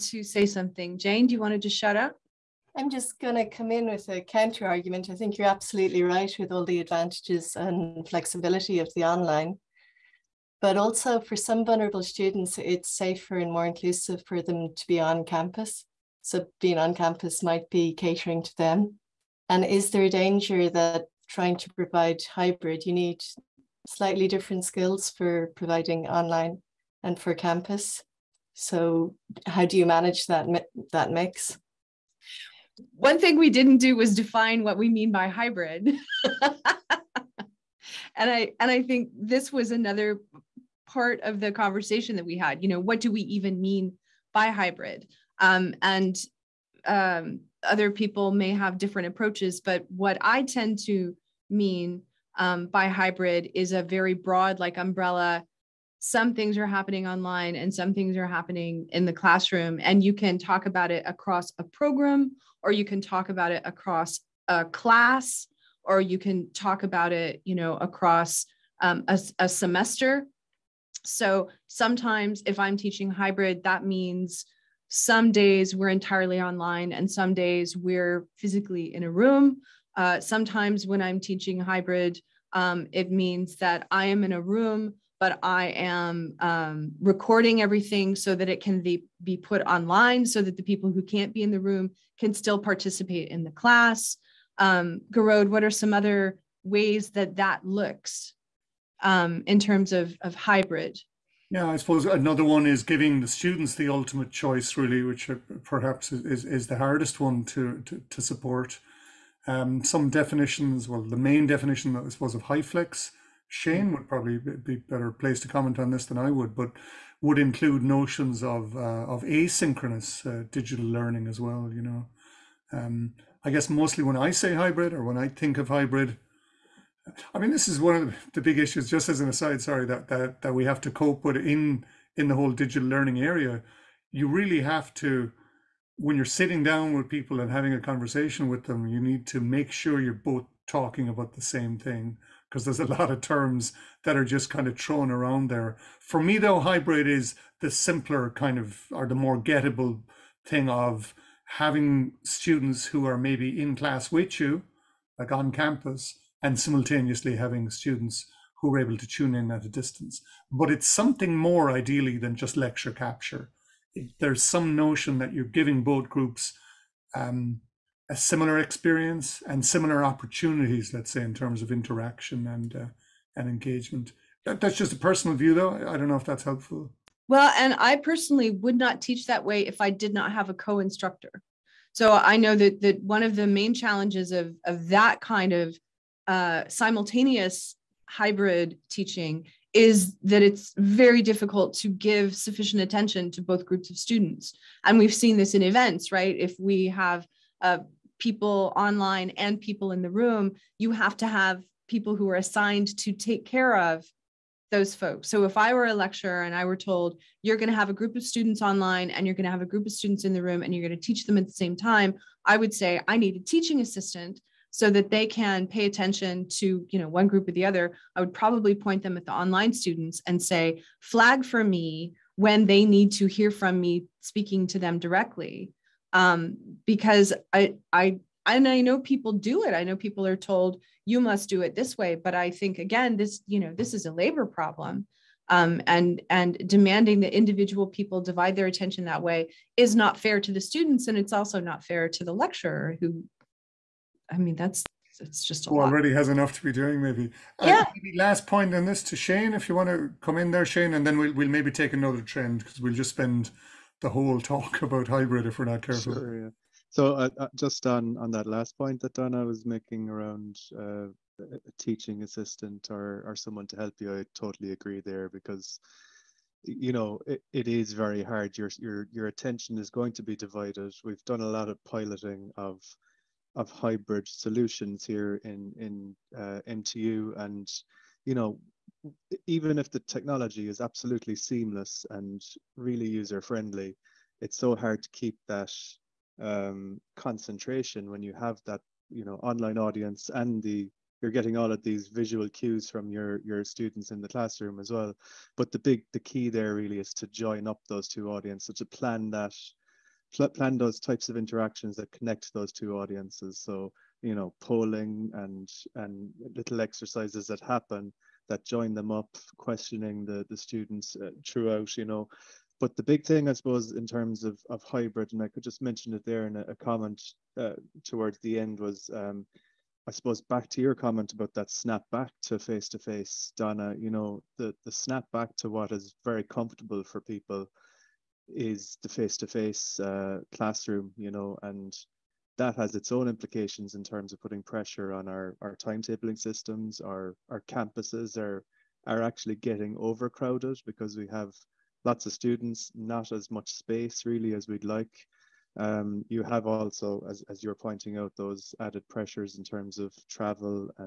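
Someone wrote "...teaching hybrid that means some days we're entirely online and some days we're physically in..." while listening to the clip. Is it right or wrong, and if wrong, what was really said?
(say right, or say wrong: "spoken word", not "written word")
right.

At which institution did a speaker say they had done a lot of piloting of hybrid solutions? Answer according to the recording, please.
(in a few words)
MTU.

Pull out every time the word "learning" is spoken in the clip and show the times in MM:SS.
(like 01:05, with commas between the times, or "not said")
02:00, 02:12.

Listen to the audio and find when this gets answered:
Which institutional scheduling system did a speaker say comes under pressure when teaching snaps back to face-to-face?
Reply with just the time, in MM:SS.
05:35.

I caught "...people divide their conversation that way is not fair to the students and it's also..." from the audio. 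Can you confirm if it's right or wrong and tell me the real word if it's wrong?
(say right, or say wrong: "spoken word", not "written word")
wrong: "attention", not "conversation".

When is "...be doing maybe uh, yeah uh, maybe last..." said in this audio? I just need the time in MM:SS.
04:06.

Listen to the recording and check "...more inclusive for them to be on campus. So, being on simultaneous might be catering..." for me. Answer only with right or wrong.
wrong.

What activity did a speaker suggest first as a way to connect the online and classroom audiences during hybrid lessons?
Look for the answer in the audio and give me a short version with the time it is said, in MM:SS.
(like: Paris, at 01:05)
polling, at 05:04.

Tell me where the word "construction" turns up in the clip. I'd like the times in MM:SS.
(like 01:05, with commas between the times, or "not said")
not said.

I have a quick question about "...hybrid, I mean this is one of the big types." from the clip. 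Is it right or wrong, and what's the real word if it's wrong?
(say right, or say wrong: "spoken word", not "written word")
wrong: "issues", not "types".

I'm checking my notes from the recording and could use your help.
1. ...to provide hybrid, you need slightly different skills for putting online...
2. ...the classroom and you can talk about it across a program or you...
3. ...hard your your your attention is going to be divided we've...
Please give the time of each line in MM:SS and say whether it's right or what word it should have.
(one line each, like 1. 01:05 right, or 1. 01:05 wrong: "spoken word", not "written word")
1. 00:21 wrong: "providing", not "putting"
2. 00:59 right
3. 04:28 right.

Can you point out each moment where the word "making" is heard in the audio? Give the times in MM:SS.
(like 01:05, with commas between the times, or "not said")
04:19.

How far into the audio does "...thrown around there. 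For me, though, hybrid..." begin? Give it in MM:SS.
02:24.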